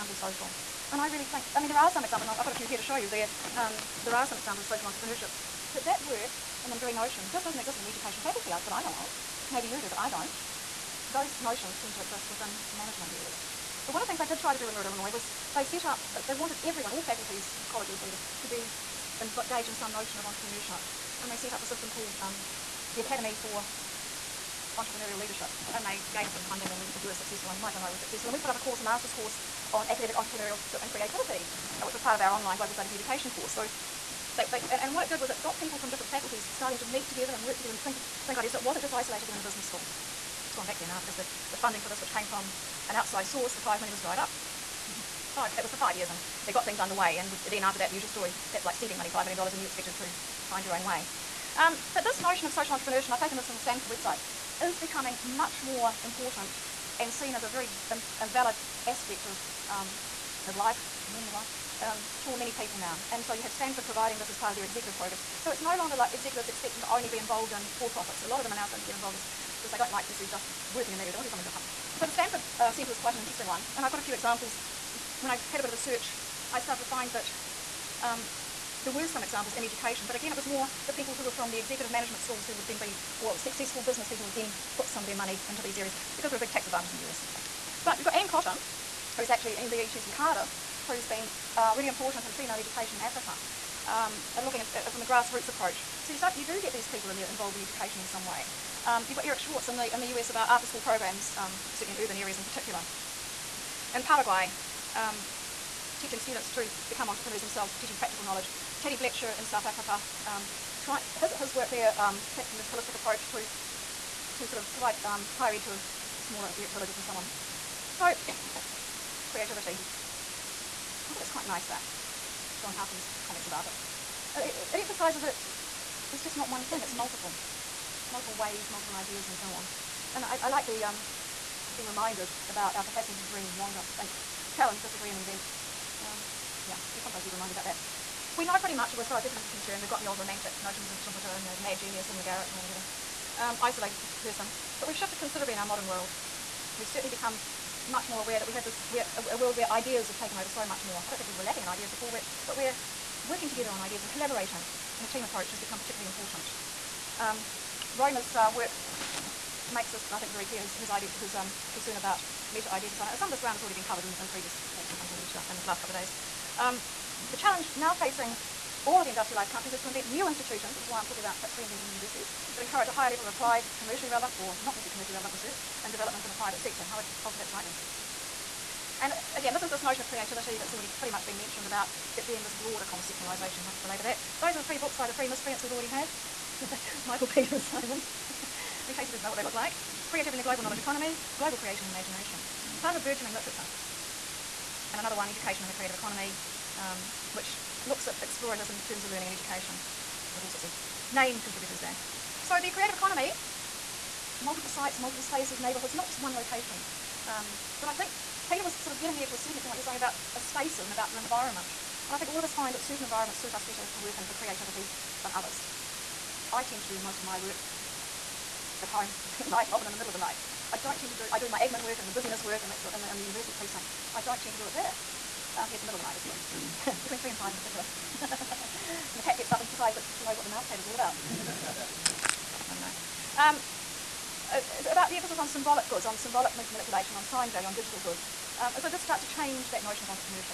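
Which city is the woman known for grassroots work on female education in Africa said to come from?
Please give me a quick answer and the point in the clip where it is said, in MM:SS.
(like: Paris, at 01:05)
Cardiff, at 01:30.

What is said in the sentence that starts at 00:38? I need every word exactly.
So it wasn't just isolated in the business school.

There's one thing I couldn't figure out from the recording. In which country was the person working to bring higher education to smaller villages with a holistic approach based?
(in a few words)
South Africa.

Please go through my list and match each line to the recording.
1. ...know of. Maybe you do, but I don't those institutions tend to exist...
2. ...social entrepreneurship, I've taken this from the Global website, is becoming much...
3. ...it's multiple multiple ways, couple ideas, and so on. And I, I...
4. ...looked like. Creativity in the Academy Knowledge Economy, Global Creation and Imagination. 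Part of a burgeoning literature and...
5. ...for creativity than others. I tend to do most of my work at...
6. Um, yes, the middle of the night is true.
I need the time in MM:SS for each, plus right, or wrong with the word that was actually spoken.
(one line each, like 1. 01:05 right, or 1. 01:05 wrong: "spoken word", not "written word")
1. 00:08 wrong: "notions", not "institutions"
2. 00:52 wrong: "Stanford", not "Global"
3. 02:06 wrong: "multiple", not "couple"
4. 03:09 wrong: "Global", not "Academy"
5. 03:34 right
6. 03:45 right.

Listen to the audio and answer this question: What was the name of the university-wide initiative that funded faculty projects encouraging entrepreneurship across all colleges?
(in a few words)
Academy for Entrepreneurial Leadership.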